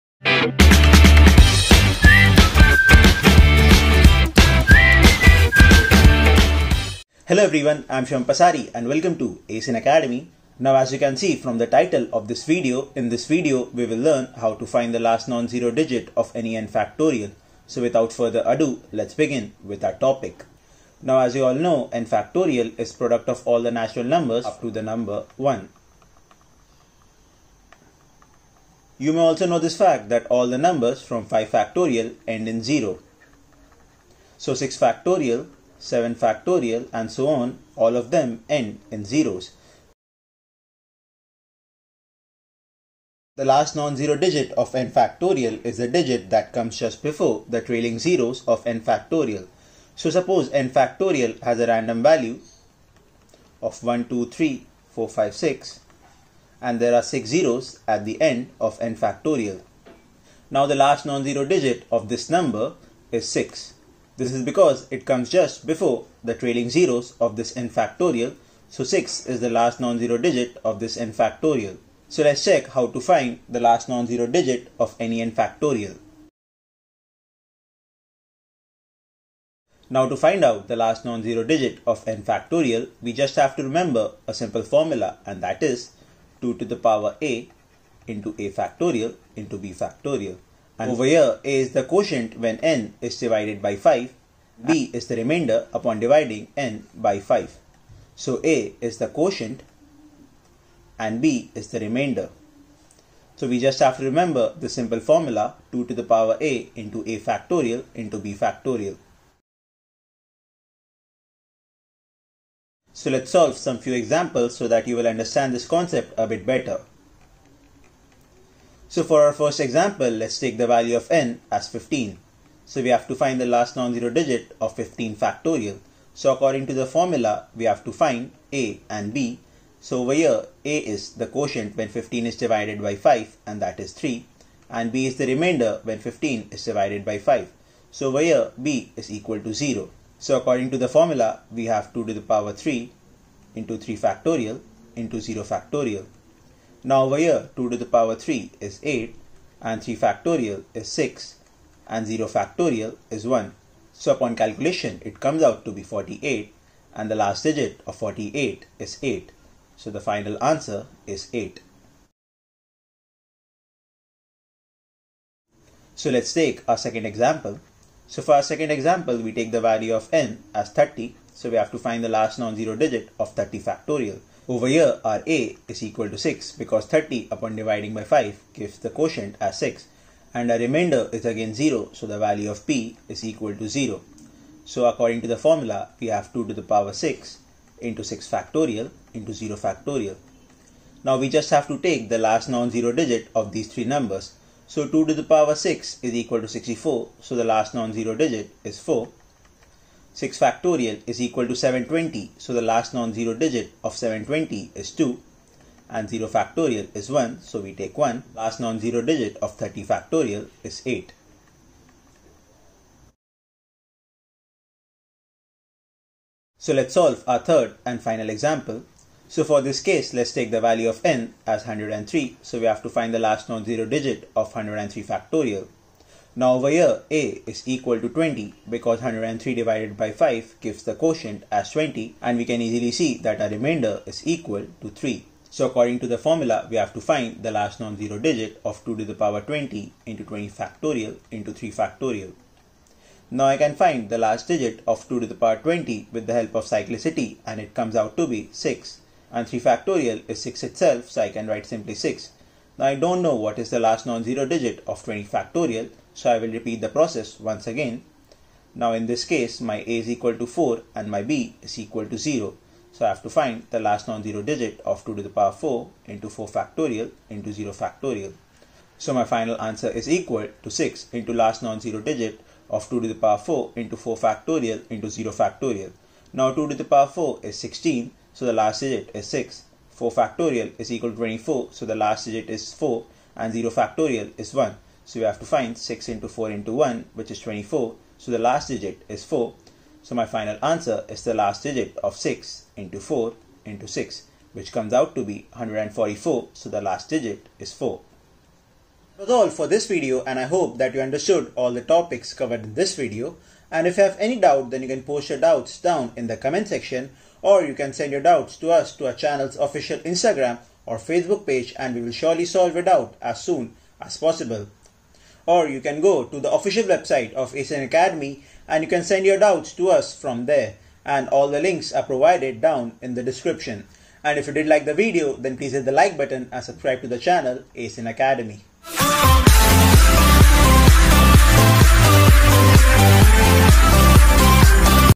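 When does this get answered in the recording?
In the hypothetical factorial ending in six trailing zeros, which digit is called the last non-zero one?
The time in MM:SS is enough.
01:00.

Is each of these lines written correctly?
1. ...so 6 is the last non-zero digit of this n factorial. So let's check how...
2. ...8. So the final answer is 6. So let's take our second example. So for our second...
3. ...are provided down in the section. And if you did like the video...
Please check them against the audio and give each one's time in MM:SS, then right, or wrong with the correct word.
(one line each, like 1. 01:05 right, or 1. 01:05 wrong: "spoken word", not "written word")
1. 01:08 right
2. 02:39 wrong: "8", not "6"
3. 05:21 wrong: "description", not "section".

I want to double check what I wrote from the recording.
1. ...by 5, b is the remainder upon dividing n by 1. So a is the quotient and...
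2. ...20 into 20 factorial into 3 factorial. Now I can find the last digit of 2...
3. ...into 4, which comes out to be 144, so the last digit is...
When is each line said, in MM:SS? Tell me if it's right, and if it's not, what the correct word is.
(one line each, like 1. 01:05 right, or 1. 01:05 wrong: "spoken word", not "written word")
1. 01:33 wrong: "5", not "1"
2. 03:59 right
3. 04:53 wrong: "6", not "4".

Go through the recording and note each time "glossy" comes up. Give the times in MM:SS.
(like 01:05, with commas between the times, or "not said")
not said.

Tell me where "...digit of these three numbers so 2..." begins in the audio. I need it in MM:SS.
03:12.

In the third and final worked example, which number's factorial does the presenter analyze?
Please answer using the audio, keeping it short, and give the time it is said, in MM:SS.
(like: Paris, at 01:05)
103, at 03:40.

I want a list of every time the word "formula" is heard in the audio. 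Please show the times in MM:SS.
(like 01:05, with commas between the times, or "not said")
01:24, 01:44, 02:06, 02:20, 03:05, 03:56.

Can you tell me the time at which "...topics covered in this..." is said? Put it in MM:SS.
05:01.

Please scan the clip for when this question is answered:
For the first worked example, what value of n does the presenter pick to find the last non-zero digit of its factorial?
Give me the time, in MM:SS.
02:00.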